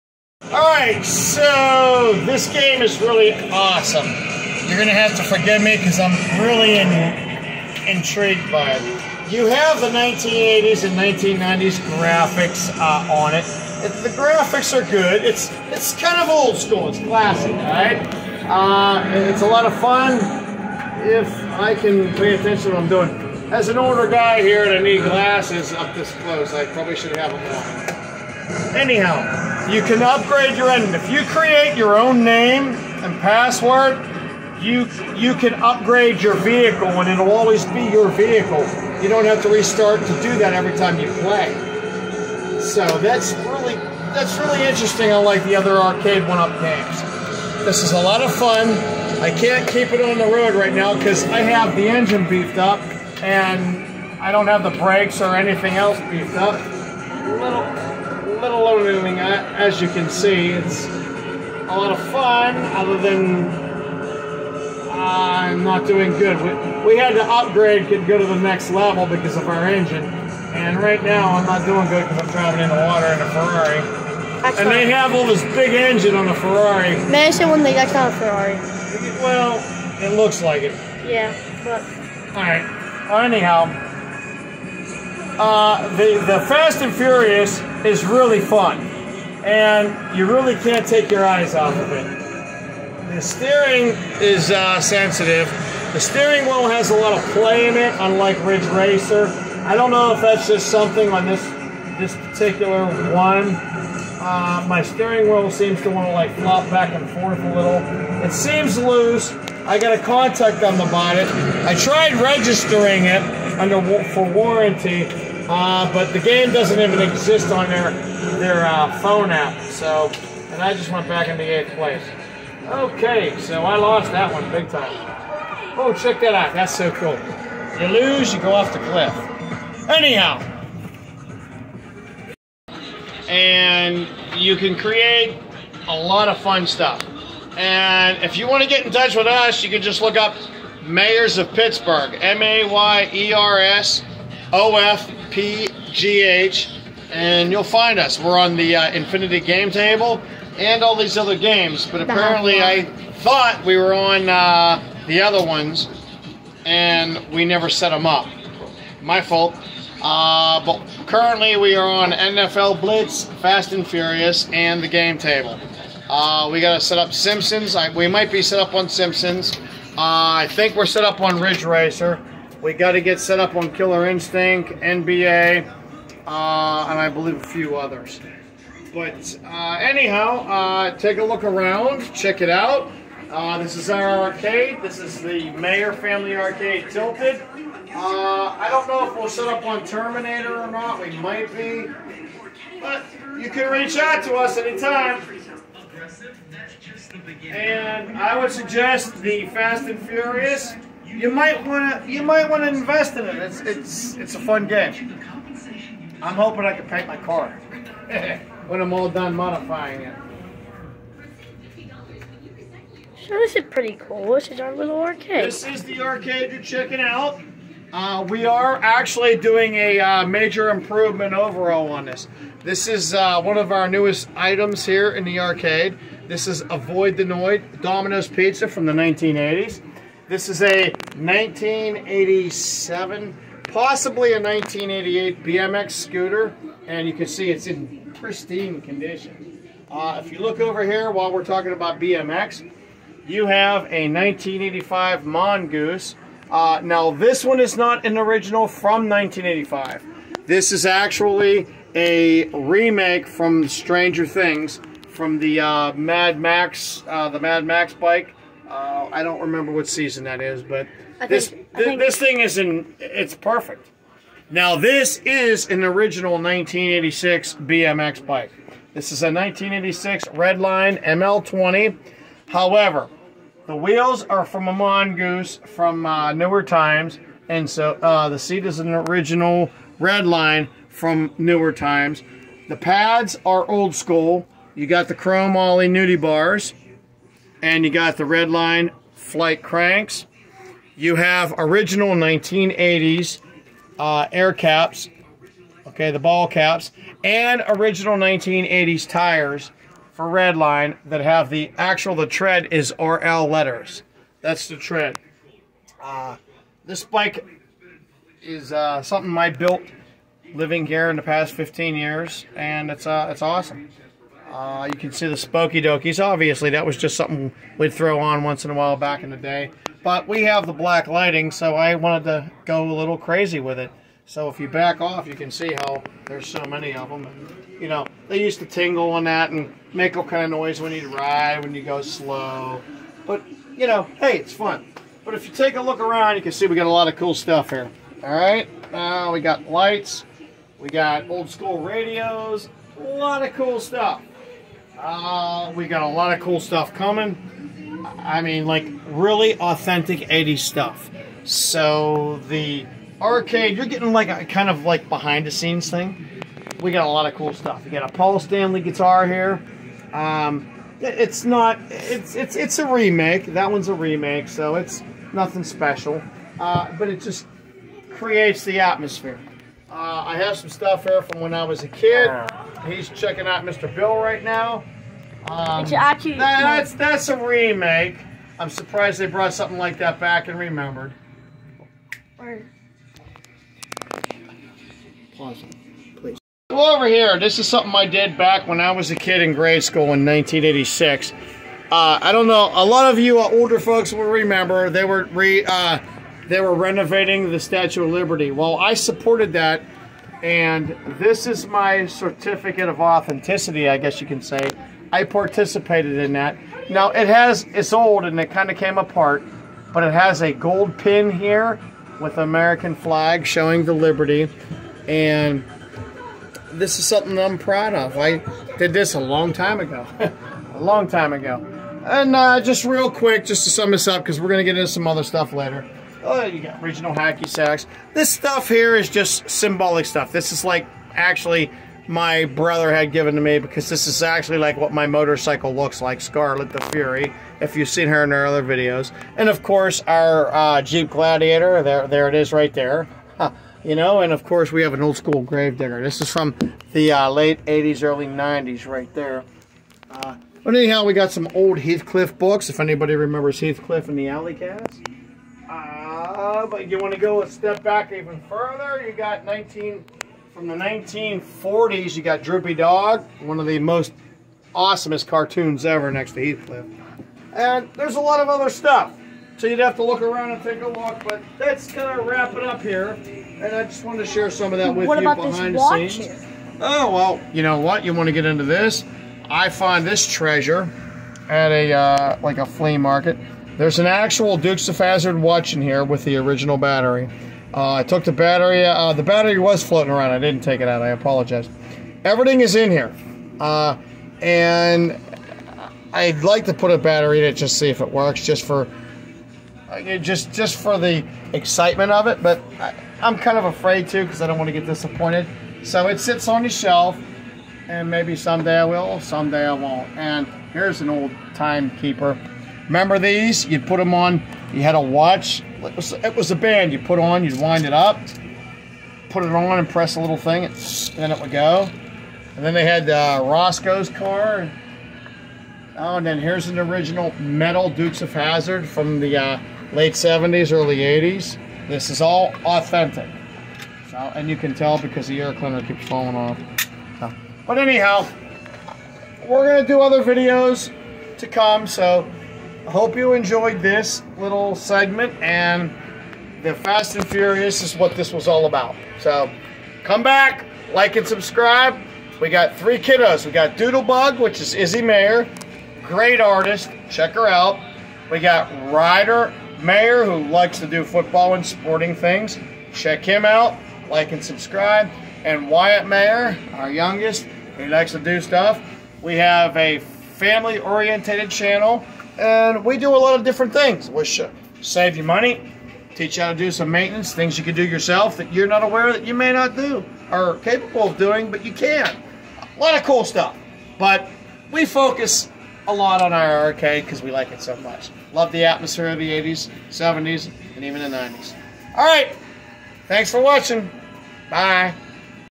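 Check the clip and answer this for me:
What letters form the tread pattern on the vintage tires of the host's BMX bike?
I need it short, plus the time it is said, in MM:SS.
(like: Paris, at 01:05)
RL, at 05:02.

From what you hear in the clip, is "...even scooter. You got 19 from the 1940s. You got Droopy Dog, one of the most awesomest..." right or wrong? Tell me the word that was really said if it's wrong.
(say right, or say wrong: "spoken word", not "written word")
wrong: "further", not "scooter".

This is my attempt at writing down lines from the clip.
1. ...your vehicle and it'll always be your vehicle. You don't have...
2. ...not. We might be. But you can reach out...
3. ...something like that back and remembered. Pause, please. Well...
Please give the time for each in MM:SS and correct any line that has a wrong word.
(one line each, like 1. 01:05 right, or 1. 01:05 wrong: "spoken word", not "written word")
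1. 00:36 right
2. 03:10 right
3. 06:19 right.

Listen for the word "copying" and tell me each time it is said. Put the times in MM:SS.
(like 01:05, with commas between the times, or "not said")
not said.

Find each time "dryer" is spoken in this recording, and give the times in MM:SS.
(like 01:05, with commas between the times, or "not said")
not said.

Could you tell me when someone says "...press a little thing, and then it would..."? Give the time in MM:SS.
08:39.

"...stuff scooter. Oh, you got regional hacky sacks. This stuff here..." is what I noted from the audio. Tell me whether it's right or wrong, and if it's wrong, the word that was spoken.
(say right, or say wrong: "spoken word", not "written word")
wrong: "later", not "scooter".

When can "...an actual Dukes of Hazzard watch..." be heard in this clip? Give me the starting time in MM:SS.
08:03.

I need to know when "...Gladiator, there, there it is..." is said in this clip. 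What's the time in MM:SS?
07:21.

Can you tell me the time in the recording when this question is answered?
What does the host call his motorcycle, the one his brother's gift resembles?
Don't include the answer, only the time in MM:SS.
07:16.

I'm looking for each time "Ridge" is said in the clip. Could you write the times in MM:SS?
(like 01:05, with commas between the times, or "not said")
01:38, 02:51.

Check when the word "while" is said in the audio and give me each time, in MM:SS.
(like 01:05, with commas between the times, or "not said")
04:01, 05:18.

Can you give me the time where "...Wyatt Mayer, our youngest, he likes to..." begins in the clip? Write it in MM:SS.
09:25.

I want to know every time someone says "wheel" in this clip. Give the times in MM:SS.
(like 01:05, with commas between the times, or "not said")
01:36, 01:45, 04:33.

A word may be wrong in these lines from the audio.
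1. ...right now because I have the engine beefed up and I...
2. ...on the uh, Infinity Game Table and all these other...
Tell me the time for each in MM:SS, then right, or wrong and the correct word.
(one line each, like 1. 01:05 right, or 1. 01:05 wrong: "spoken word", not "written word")
1. 00:50 right
2. 02:28 right.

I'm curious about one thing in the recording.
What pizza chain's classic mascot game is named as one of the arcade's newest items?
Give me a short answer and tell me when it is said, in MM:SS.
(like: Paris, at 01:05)
Domino's Pizza, at 03:47.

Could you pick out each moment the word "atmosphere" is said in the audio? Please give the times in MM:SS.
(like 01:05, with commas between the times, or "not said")
06:08, 09:48.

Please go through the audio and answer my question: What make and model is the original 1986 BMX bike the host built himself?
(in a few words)
Redline ML20.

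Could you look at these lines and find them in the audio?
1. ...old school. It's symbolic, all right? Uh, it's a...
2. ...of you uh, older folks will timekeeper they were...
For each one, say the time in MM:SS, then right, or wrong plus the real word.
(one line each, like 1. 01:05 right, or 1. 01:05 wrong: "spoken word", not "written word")
1. 00:16 wrong: "classic", not "symbolic"
2. 06:33 wrong: "remember", not "timekeeper".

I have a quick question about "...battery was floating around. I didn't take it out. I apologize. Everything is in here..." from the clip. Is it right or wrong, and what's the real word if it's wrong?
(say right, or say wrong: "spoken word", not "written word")
right.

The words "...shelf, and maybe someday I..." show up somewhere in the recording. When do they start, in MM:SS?
08:26.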